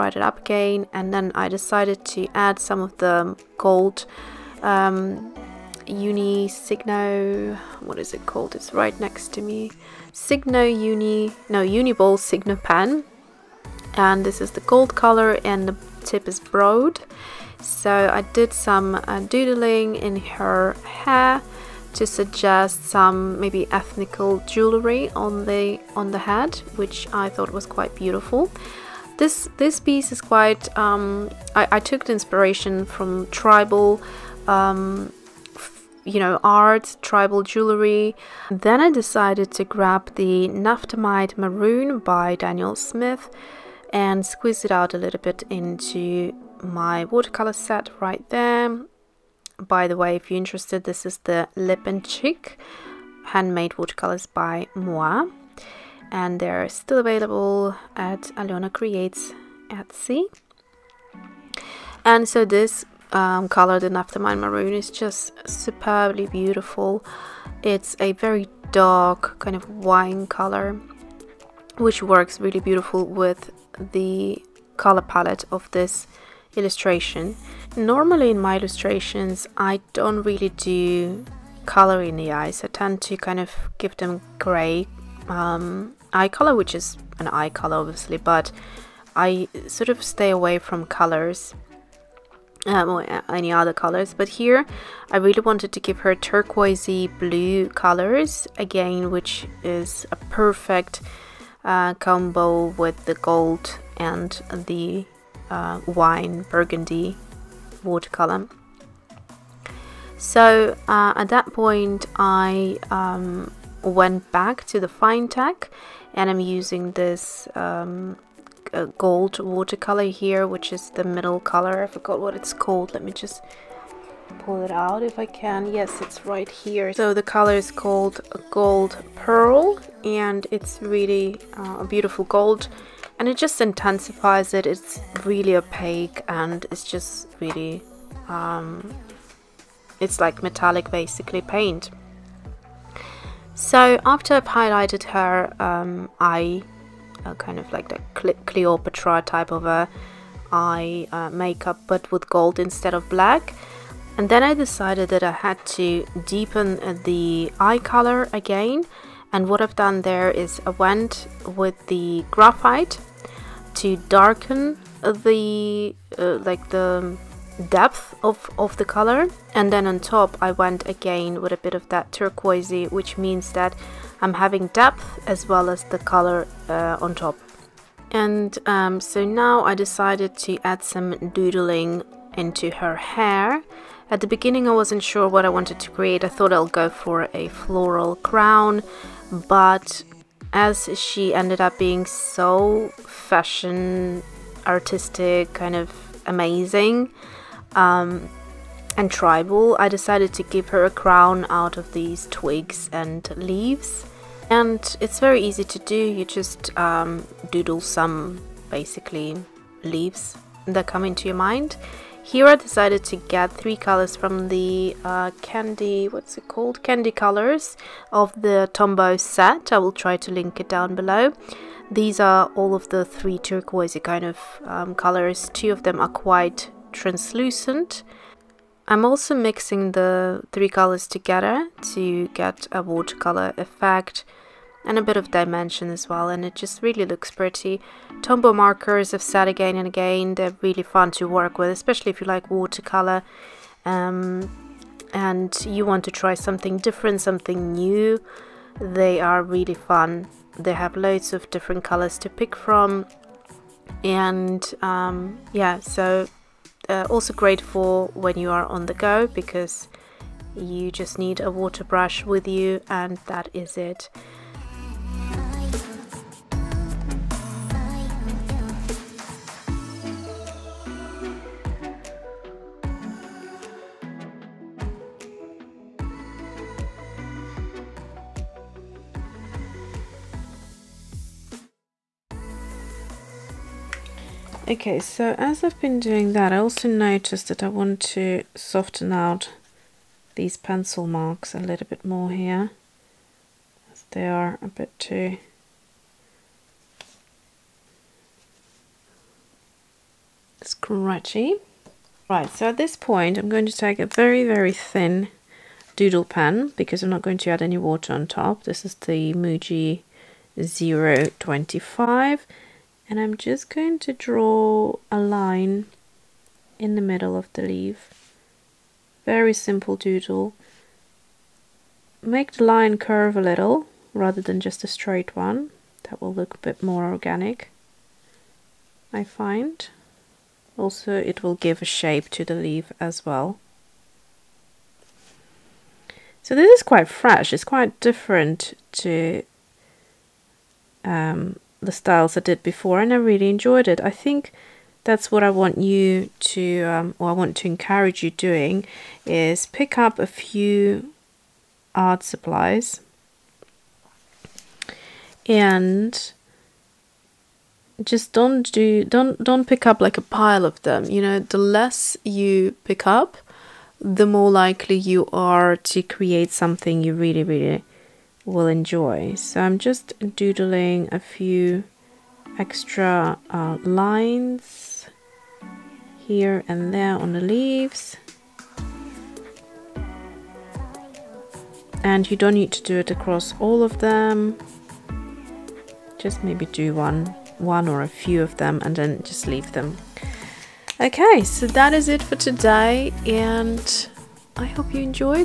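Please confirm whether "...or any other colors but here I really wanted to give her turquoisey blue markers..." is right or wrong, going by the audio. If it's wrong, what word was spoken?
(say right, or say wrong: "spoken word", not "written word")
wrong: "colors", not "markers".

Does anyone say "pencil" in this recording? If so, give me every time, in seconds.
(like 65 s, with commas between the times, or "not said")
290 s.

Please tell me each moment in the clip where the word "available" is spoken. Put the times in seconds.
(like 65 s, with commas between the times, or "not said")
56 s.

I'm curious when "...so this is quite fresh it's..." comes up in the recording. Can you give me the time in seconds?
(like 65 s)
336 s.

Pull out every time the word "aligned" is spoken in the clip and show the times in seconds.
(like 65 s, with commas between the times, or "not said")
not said.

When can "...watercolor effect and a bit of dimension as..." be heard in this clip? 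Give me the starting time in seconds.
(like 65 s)
232 s.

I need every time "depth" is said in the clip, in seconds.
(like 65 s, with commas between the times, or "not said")
167 s, 174 s.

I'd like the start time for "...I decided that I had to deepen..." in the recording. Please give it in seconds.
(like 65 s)
154 s.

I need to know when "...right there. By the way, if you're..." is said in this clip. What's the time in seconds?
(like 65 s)
47 s.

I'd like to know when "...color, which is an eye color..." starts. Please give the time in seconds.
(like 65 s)
86 s.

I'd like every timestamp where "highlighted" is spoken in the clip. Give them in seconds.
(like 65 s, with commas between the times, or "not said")
144 s.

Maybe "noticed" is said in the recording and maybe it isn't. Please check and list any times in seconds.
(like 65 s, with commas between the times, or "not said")
286 s.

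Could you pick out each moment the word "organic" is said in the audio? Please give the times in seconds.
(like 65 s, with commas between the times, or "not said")
327 s.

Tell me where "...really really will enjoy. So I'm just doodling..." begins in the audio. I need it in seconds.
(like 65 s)
367 s.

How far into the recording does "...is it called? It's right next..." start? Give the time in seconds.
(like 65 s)
7 s.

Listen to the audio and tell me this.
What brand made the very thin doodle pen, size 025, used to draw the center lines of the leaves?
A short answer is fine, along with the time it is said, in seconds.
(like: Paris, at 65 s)
Muji, at 309 s.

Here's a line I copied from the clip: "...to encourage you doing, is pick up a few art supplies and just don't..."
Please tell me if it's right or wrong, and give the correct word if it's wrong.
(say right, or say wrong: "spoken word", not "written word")
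right.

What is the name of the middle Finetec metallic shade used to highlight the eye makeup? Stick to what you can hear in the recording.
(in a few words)
Gold Pearl.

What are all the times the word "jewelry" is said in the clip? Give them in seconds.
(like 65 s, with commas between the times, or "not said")
24 s, 37 s.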